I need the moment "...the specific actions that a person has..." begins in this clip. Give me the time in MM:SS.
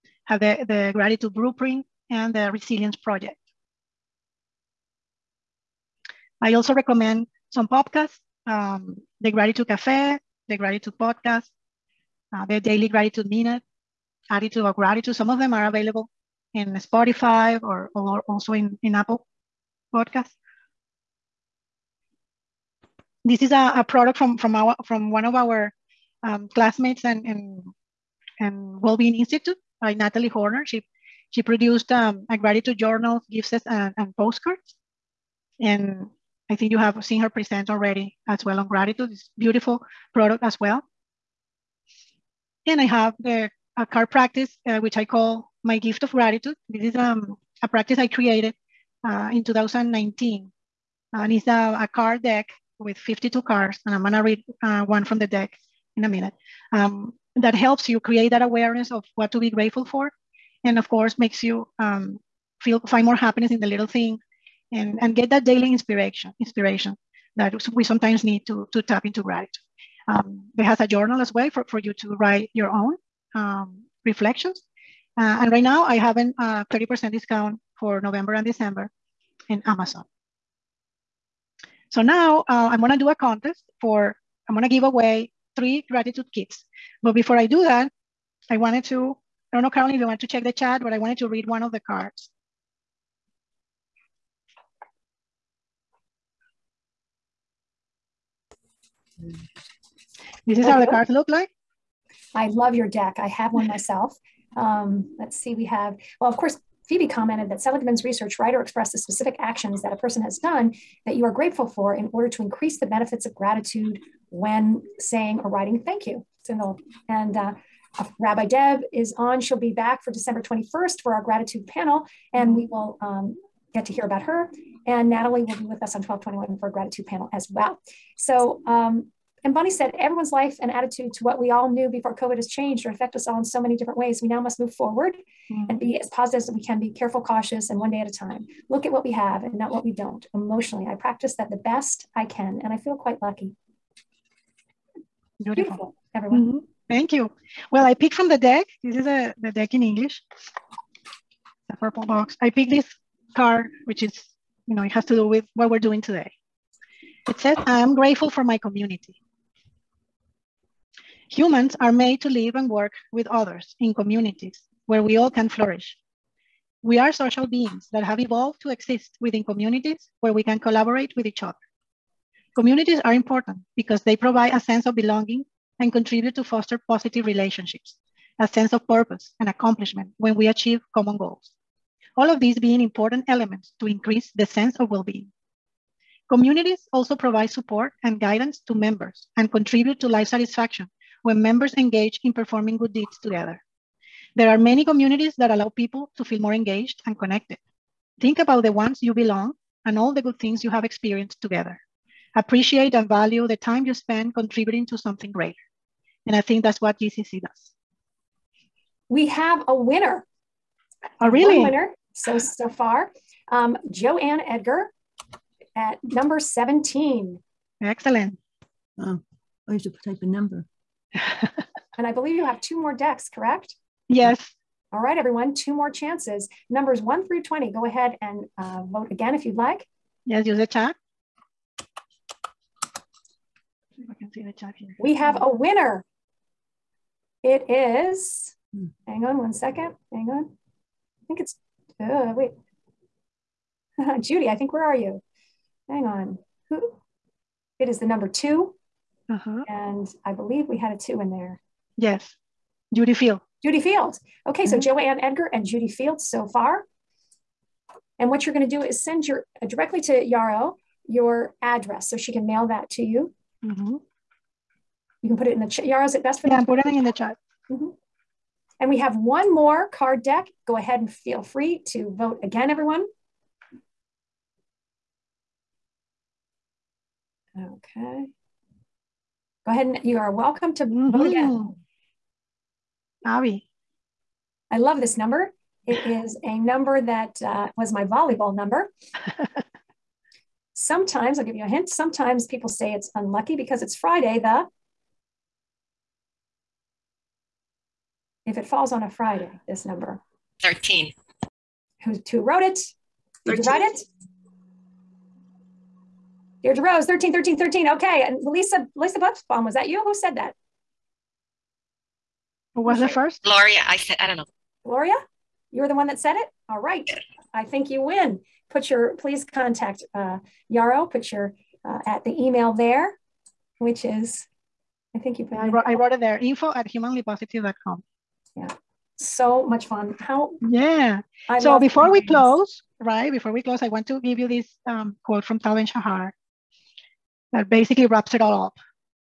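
01:48.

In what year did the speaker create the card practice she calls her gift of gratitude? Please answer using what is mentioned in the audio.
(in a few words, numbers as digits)
2019.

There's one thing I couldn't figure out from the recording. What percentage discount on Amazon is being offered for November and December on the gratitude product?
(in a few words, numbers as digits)
30%.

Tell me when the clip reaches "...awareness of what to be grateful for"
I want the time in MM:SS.
00:58.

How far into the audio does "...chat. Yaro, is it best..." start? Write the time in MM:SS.
04:25.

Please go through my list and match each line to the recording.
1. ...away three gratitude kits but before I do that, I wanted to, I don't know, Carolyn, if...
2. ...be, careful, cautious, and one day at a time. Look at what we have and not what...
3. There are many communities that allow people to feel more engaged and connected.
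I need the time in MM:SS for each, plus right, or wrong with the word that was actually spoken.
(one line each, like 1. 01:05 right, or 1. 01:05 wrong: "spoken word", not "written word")
1. 01:24 right
2. 02:16 right
3. 03:14 right.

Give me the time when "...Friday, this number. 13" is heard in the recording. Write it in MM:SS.
04:59.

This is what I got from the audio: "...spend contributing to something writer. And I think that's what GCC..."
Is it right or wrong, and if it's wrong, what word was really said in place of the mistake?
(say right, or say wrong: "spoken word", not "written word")
wrong: "greater", not "writer".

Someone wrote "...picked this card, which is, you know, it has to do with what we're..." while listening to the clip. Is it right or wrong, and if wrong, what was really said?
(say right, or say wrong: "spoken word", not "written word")
right.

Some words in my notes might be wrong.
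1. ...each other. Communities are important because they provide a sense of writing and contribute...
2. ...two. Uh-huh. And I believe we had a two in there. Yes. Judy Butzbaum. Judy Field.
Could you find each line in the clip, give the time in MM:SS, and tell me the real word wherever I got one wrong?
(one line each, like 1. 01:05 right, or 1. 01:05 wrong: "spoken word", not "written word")
1. 02:51 wrong: "belonging", not "writing"
2. 04:08 wrong: "Field", not "Butzbaum".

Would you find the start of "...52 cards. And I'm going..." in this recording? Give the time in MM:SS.
00:52.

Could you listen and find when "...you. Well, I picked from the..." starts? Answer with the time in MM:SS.
02:27.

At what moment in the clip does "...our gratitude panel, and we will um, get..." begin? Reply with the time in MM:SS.
02:01.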